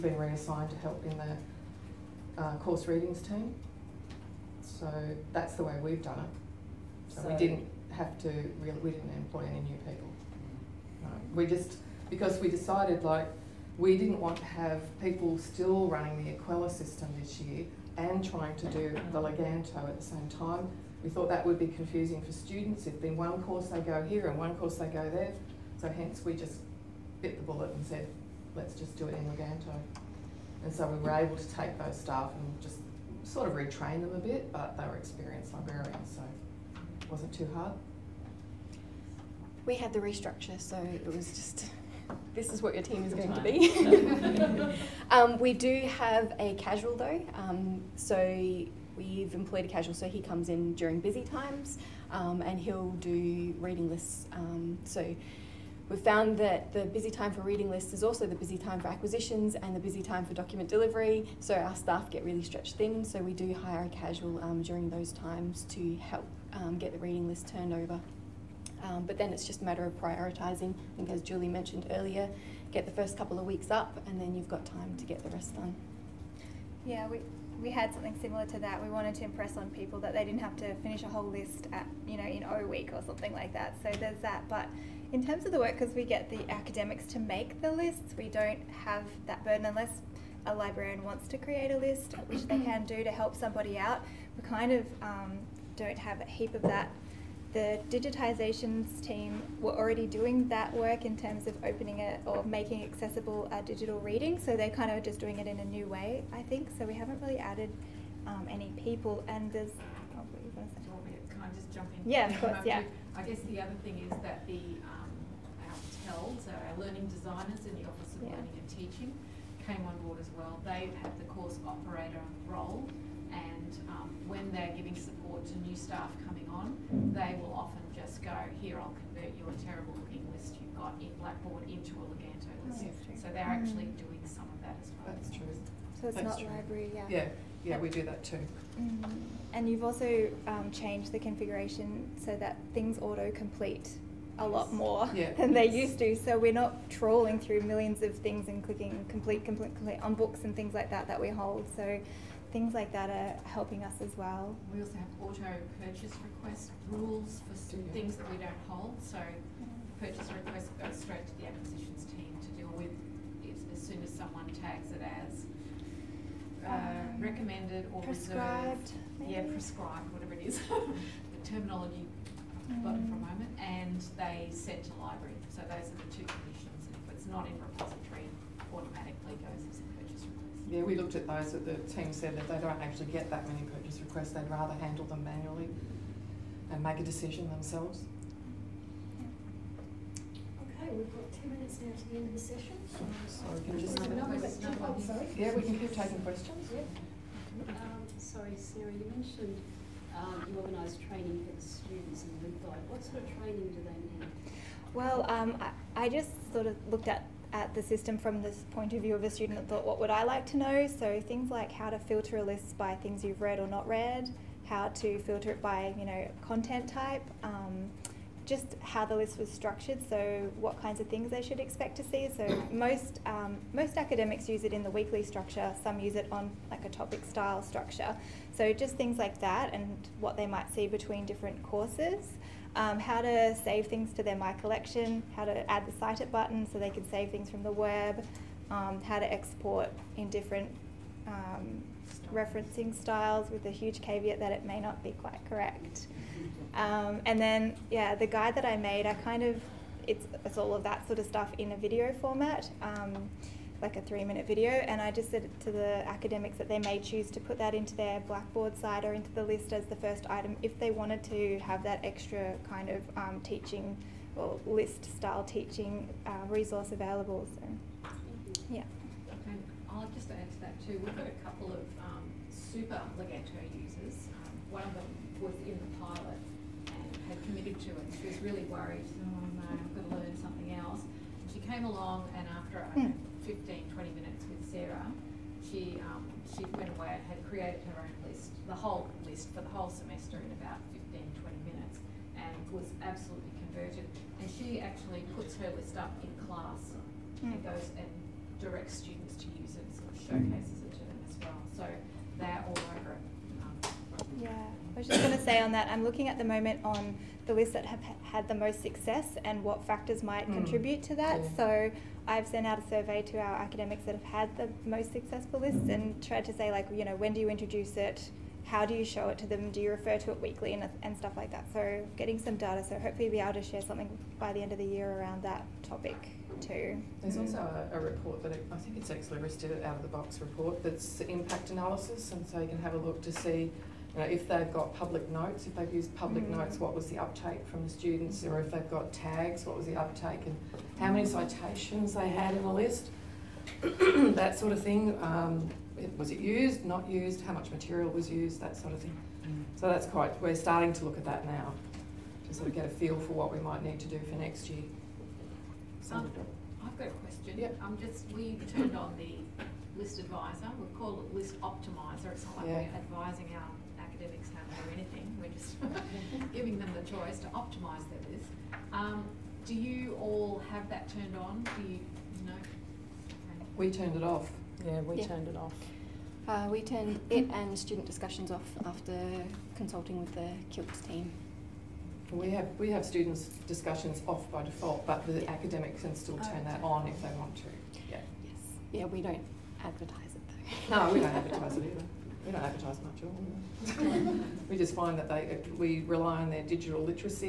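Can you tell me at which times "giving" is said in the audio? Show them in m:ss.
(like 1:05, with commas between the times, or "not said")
2:04, 6:06.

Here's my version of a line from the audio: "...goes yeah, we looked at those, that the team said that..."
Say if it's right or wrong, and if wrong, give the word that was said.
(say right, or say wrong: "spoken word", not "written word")
right.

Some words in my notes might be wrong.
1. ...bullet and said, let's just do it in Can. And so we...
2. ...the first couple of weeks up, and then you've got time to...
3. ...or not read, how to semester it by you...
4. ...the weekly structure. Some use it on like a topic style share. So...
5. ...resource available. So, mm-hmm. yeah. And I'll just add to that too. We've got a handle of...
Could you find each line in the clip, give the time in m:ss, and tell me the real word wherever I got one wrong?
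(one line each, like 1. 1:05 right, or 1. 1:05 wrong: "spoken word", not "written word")
1. 0:27 wrong: "Leganto", not "Can"
2. 1:12 right
3. 3:33 wrong: "filter", not "semester"
4. 3:44 wrong: "structure", not "share"
5. 4:26 wrong: "couple", not "handle".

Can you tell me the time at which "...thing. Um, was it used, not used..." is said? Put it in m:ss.
5:44.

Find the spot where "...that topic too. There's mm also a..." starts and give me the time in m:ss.
5:25.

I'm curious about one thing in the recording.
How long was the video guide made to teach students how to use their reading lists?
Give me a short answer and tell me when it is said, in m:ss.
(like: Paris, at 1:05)
3 minutes, at 4:14.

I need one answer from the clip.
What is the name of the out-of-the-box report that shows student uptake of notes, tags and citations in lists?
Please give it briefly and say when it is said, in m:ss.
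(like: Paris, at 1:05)
Impact analysis, at 5:31.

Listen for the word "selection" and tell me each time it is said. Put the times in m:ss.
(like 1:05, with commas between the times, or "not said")
not said.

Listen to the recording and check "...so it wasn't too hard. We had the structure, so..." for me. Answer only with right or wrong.
wrong.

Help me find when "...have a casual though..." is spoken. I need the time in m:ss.
0:45.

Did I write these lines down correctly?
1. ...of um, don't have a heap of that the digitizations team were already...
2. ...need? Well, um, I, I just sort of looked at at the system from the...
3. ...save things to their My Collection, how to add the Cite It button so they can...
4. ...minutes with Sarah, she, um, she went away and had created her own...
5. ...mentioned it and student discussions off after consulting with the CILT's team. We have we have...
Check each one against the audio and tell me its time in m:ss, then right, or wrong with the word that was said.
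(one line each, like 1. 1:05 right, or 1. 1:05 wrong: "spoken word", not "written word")
1. 1:34 right
2. 3:24 right
3. 3:53 right
4. 4:44 right
5. 6:16 wrong: "turned", not "mentioned".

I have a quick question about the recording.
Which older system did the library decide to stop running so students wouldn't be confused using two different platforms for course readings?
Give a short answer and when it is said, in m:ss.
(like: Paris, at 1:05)
Equella, at 0:16.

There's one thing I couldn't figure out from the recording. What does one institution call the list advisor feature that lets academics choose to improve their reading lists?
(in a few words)
List optimizer.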